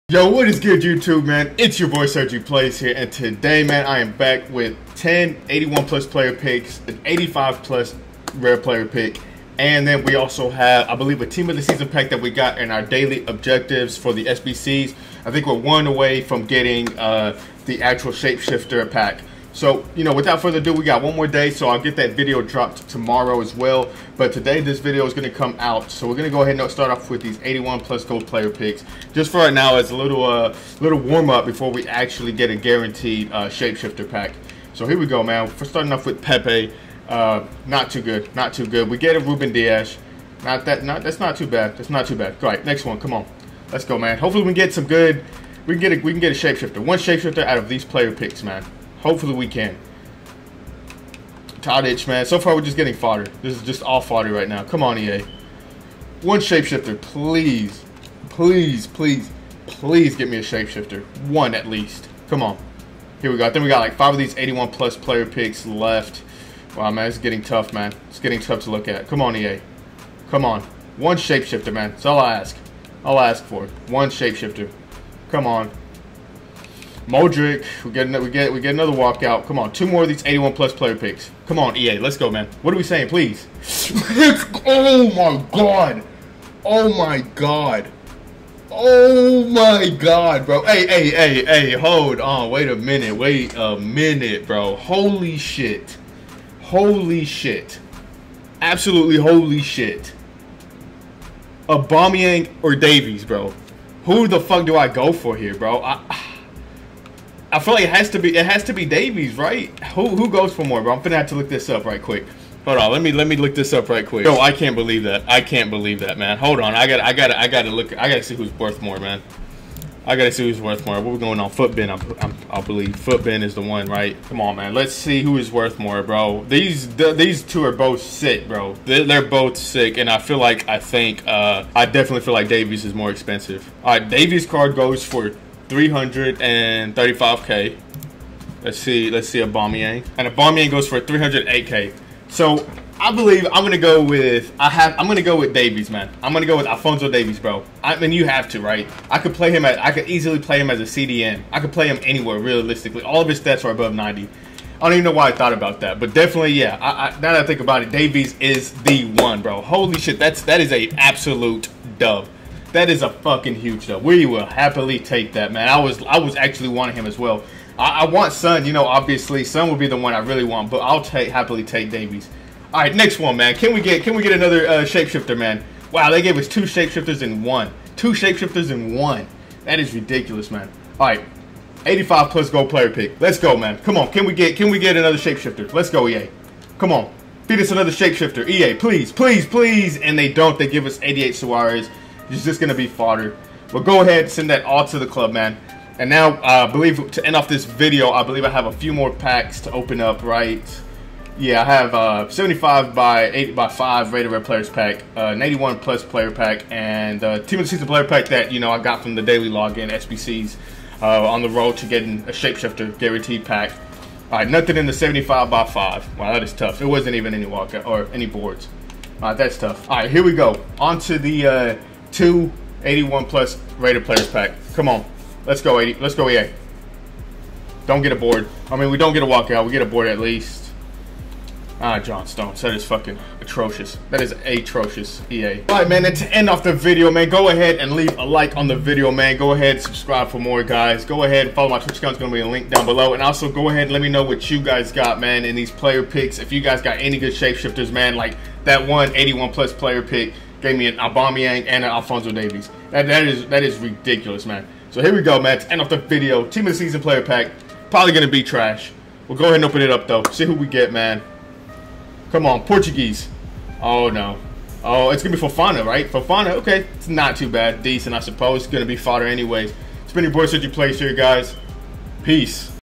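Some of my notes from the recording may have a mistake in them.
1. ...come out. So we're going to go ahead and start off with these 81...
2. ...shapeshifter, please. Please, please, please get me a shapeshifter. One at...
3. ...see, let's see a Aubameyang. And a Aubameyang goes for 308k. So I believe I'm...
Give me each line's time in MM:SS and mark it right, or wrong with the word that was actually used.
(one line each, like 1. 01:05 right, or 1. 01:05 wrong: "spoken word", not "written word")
1. 00:25 right
2. 00:56 right
3. 02:18 right.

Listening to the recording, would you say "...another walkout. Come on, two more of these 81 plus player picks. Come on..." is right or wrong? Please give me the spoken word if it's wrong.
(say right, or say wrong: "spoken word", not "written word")
right.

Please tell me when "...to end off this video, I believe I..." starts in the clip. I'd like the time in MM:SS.
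03:17.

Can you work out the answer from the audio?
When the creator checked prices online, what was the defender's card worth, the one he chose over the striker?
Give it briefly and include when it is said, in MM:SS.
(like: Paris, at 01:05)
335k, at 02:15.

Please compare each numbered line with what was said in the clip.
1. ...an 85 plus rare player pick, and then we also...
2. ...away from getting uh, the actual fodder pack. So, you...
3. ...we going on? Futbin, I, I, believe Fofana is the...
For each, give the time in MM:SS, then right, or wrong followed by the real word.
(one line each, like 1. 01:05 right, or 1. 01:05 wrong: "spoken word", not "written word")
1. 00:06 right
2. 00:15 wrong: "shapeshifter", not "fodder"
3. 02:01 wrong: "Futbin", not "Fofana".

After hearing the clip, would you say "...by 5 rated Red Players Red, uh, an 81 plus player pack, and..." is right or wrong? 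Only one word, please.
wrong.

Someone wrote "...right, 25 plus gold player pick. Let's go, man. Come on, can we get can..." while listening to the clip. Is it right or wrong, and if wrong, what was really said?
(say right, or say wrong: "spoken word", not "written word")
wrong: "85", not "25".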